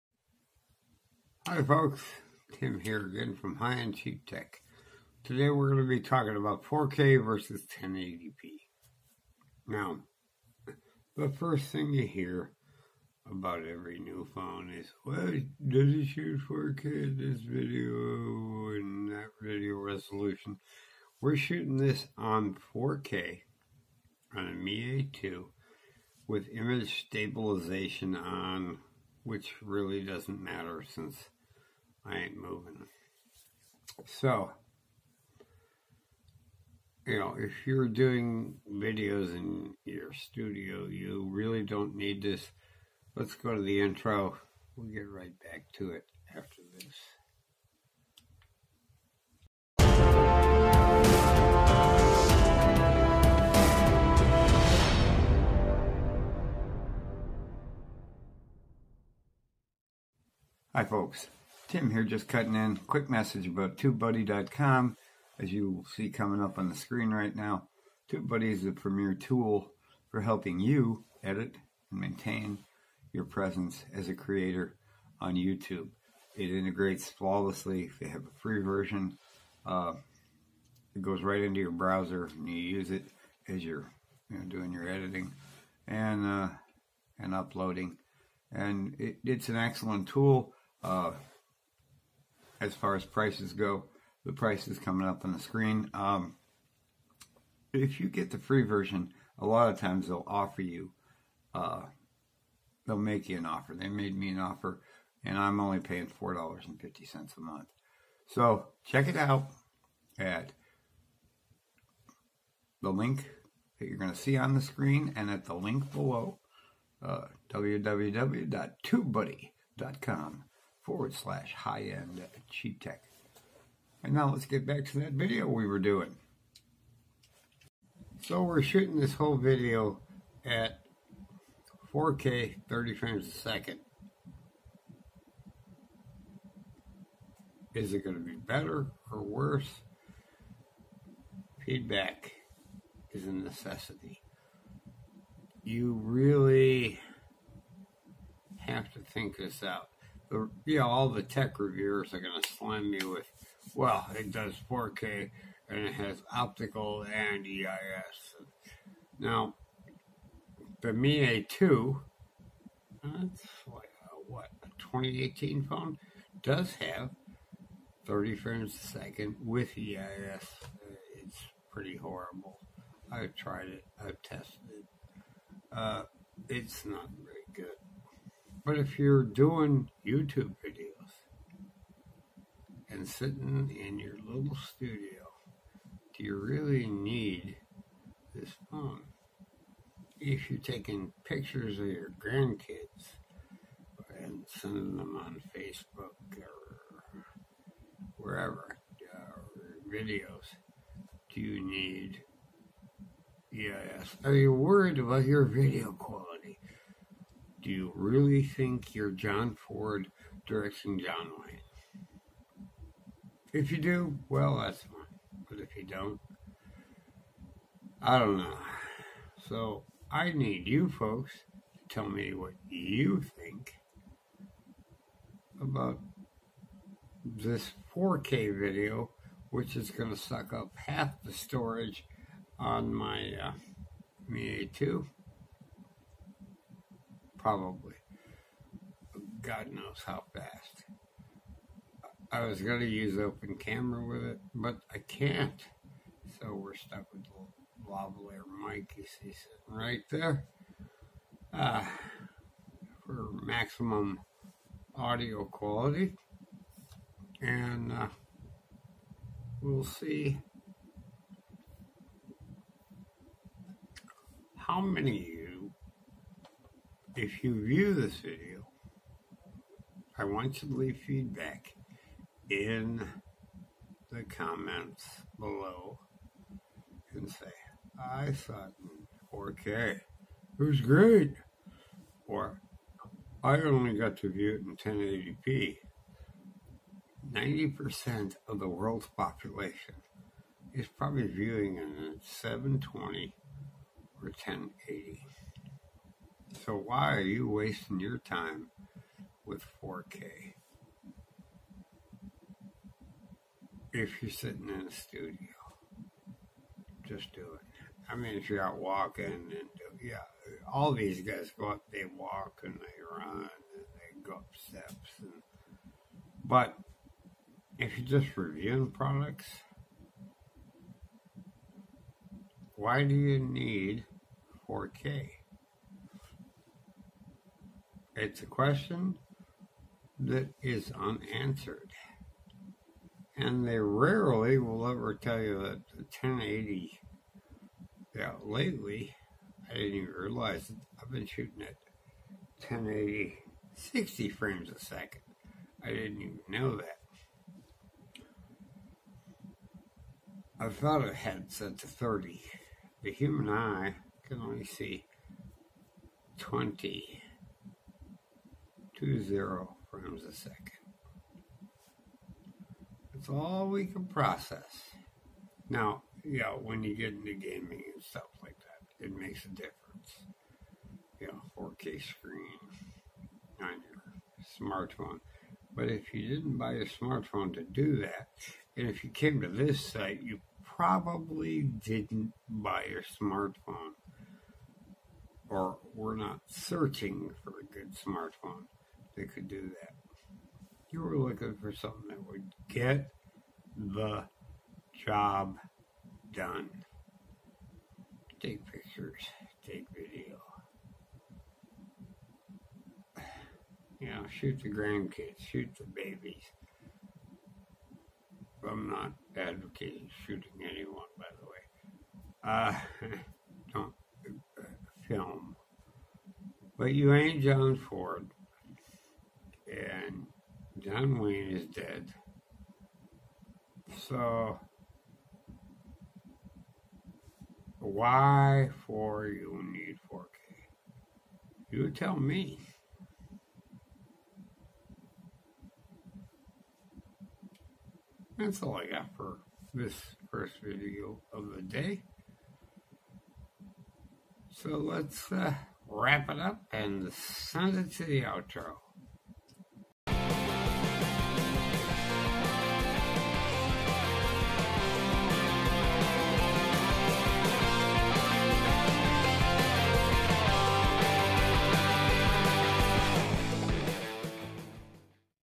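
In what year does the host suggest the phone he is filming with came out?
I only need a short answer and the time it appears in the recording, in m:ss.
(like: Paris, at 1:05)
2018, at 2:44.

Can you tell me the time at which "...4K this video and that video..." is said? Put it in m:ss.
0:16.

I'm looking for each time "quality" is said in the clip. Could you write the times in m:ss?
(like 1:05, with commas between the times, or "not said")
3:25, 4:15.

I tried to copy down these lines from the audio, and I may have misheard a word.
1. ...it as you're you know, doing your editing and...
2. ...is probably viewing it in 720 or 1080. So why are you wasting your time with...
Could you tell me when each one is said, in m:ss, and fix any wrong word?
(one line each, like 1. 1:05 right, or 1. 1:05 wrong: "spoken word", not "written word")
1. 1:22 right
2. 4:50 right.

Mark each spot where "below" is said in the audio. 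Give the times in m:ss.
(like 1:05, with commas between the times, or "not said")
1:55, 4:35.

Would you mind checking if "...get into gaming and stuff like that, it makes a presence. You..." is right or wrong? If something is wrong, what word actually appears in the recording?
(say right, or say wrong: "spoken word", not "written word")
wrong: "difference", not "presence".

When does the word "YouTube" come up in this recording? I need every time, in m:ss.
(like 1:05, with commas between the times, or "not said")
1:15, 3:00.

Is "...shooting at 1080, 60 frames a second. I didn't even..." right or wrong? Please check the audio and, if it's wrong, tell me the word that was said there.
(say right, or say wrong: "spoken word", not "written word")
right.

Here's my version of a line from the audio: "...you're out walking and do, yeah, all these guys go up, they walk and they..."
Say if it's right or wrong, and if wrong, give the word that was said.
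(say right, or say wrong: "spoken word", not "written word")
right.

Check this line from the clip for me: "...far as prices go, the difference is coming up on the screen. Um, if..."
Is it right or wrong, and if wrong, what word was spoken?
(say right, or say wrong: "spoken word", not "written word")
wrong: "price", not "difference".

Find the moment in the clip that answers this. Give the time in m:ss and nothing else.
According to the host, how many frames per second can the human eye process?
5:56.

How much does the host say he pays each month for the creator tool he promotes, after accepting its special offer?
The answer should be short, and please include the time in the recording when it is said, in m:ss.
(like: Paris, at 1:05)
$4.50, at 1:46.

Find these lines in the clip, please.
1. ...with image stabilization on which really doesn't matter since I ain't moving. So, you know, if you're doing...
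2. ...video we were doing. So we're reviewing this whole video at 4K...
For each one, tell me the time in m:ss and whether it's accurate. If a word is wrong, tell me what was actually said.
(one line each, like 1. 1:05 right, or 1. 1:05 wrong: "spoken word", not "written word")
1. 0:26 right
2. 2:05 wrong: "shooting", not "reviewing".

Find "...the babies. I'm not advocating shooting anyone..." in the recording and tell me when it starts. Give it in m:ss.
6:45.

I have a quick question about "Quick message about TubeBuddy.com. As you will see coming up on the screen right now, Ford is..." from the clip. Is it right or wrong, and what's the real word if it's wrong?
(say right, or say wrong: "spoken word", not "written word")
wrong: "TubeBuddy", not "Ford".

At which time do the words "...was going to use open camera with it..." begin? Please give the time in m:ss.
4:02.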